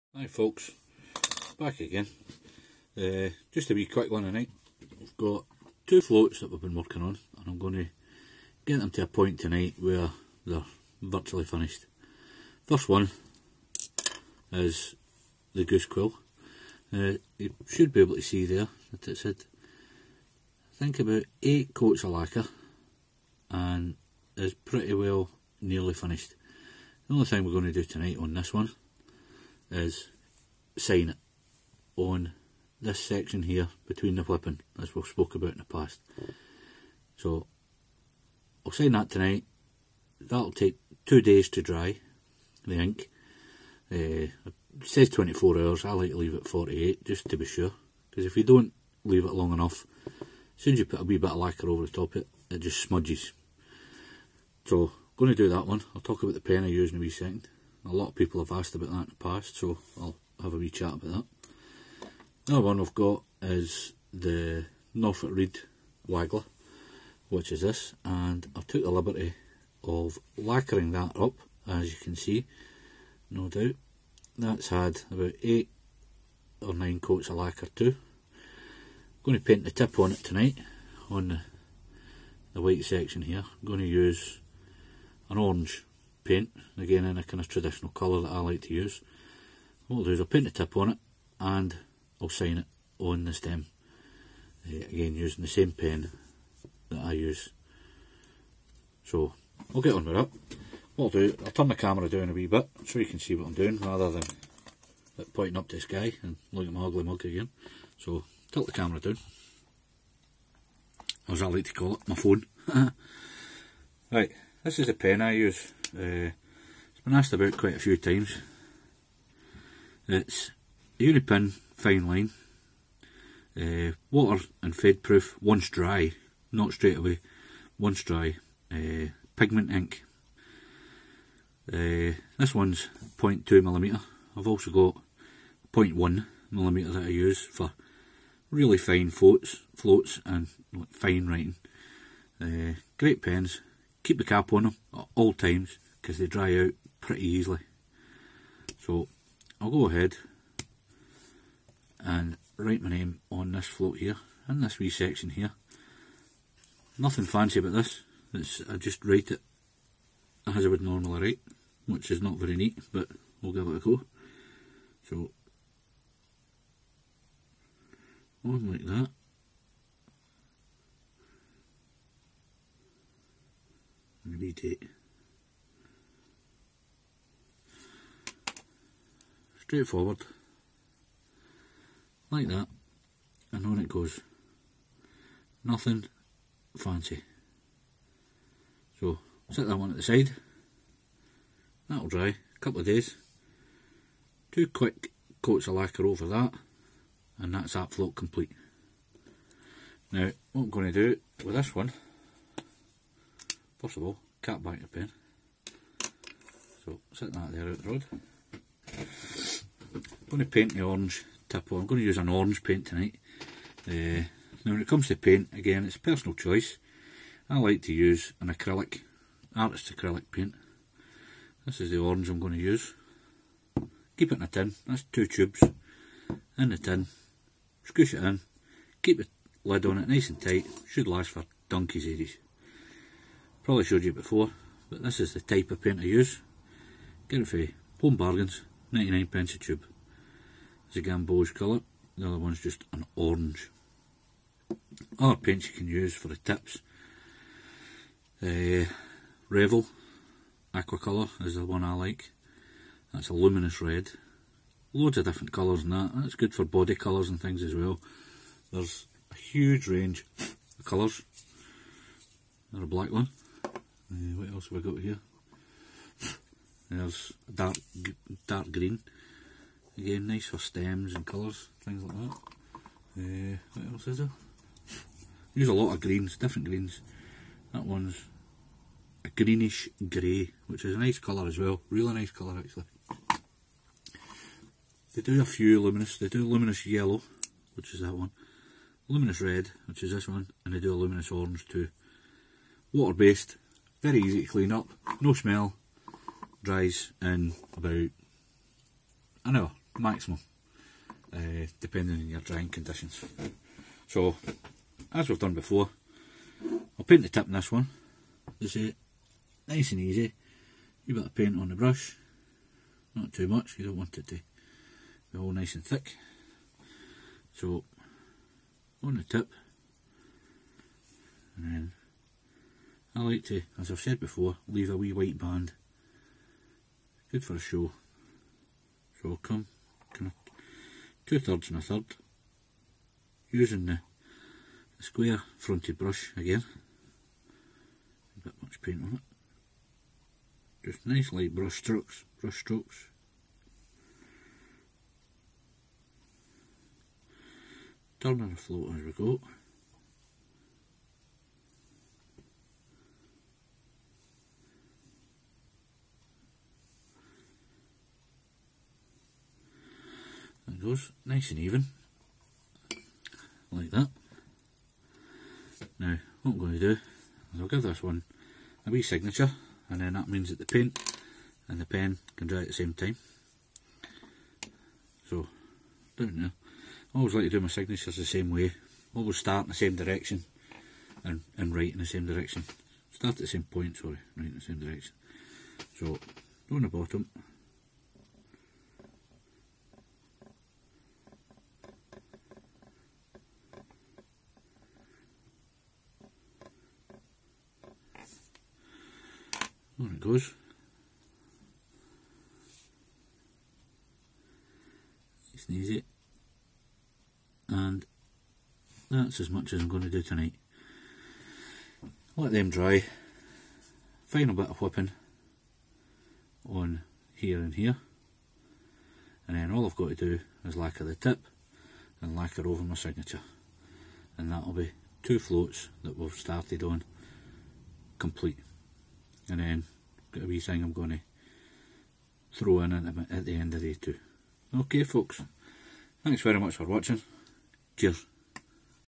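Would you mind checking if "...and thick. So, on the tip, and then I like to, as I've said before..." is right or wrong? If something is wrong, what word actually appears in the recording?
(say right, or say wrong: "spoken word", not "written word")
right.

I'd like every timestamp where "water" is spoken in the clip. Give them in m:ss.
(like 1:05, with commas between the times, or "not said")
2:04, 4:52.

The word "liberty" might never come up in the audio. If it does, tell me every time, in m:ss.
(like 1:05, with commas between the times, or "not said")
1:08.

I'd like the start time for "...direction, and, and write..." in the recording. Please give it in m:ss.
6:19.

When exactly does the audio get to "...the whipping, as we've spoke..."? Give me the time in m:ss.
0:34.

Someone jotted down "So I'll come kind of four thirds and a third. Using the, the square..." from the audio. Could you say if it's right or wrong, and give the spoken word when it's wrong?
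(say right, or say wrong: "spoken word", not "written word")
wrong: "two", not "four".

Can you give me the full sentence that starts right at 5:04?
So, as we've done before, I'll paint the tip in this one.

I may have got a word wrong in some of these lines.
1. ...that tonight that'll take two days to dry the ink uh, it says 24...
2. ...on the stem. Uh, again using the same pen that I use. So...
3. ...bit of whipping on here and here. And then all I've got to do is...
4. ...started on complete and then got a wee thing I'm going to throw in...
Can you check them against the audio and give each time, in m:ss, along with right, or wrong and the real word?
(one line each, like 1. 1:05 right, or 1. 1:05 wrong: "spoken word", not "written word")
1. 0:38 right
2. 1:32 right
3. 6:54 right
4. 7:06 right.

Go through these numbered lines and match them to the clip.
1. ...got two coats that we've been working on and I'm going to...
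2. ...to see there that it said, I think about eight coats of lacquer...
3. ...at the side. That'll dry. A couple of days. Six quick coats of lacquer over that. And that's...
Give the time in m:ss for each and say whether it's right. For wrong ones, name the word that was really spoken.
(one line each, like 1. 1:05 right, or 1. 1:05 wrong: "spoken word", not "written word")
1. 0:05 wrong: "floats", not "coats"
2. 0:18 right
3. 3:09 wrong: "Two", not "Six".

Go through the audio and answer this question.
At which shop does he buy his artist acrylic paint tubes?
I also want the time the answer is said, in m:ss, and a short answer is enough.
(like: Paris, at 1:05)
Home Bargains, at 3:58.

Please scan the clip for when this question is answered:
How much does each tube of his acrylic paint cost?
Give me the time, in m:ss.
3:58.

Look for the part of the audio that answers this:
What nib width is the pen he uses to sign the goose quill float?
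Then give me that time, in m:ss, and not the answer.
2:13.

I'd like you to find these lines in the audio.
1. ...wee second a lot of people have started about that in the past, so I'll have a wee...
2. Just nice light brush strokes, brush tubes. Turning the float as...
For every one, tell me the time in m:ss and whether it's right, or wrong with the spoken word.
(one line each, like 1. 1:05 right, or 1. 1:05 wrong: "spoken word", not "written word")
1. 0:56 wrong: "asked", not "started"
2. 5:40 wrong: "strokes", not "tubes".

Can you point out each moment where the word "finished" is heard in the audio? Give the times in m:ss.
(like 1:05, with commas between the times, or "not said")
0:11, 0:25.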